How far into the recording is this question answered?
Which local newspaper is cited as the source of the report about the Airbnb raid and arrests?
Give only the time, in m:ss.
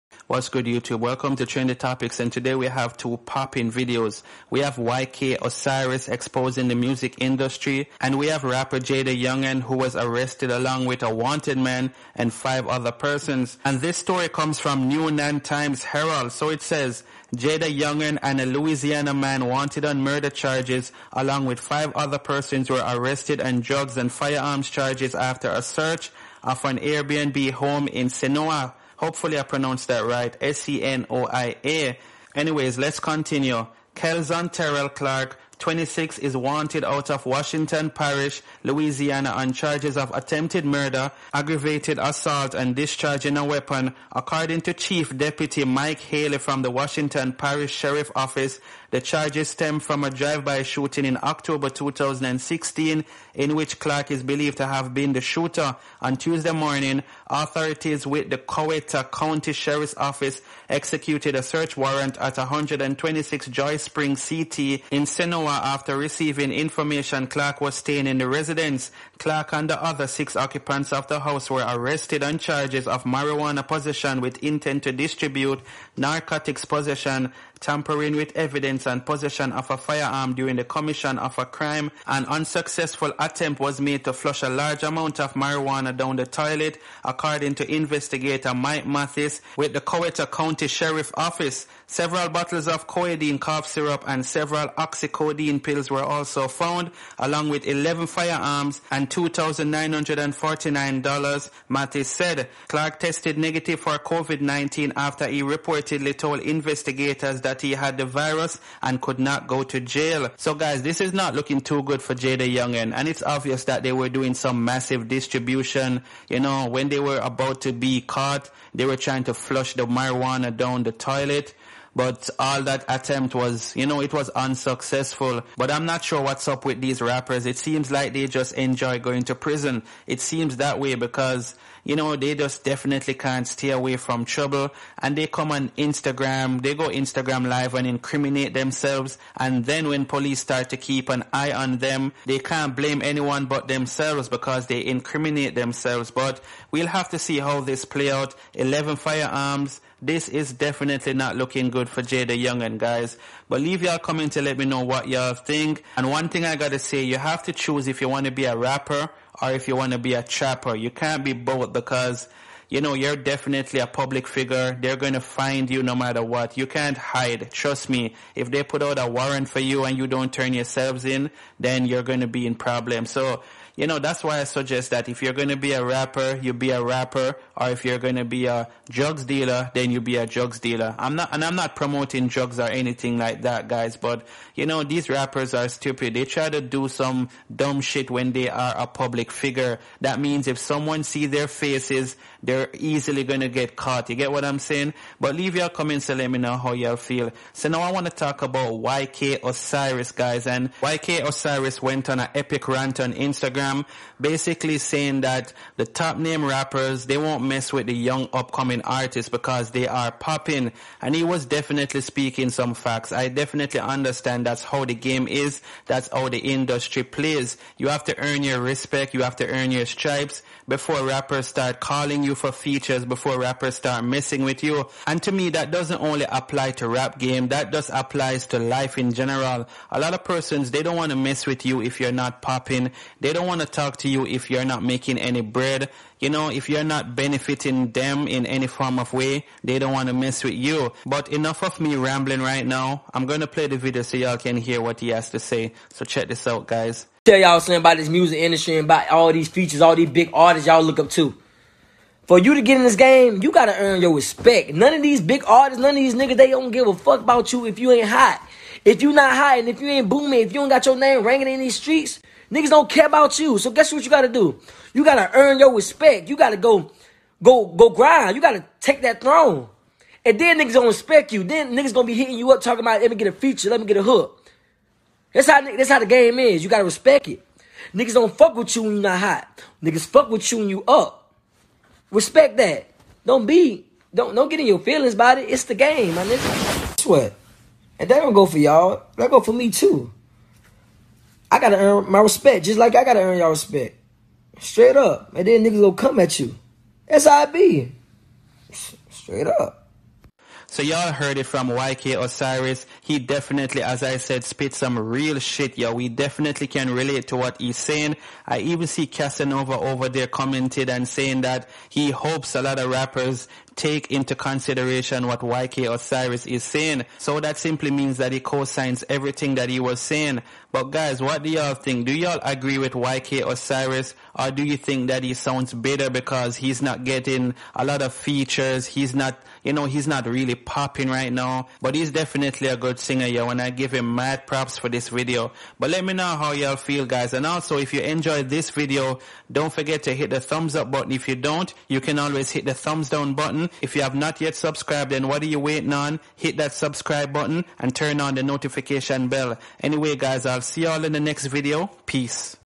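0:14.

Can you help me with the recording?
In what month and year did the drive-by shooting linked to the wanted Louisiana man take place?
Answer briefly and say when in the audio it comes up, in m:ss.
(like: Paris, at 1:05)
October 2016, at 0:51.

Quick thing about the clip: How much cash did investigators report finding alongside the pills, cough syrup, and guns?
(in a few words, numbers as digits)
$2,949.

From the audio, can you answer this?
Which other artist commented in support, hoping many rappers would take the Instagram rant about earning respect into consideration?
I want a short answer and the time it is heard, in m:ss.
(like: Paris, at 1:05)
Casanova, at 5:09.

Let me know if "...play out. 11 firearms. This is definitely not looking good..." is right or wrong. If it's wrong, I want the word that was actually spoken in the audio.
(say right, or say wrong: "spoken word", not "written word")
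right.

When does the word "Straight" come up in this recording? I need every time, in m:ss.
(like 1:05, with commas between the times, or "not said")
4:54, 4:59.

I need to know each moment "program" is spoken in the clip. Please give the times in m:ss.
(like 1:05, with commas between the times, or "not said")
3:23.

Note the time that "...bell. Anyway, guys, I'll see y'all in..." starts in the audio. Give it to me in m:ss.
5:49.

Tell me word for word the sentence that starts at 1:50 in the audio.
So guys, this is not looking too good for JayDaYoungan.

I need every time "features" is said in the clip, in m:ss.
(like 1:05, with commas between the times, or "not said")
3:42, 4:09, 4:33, 5:28.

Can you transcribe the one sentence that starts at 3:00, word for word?
I'm not, and I'm not promoting drugs or anything like that, guys, but you know, these rappers are stupid.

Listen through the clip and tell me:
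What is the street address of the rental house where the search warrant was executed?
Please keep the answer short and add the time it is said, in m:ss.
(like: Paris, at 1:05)
126 Joy Spring CT, at 1:02.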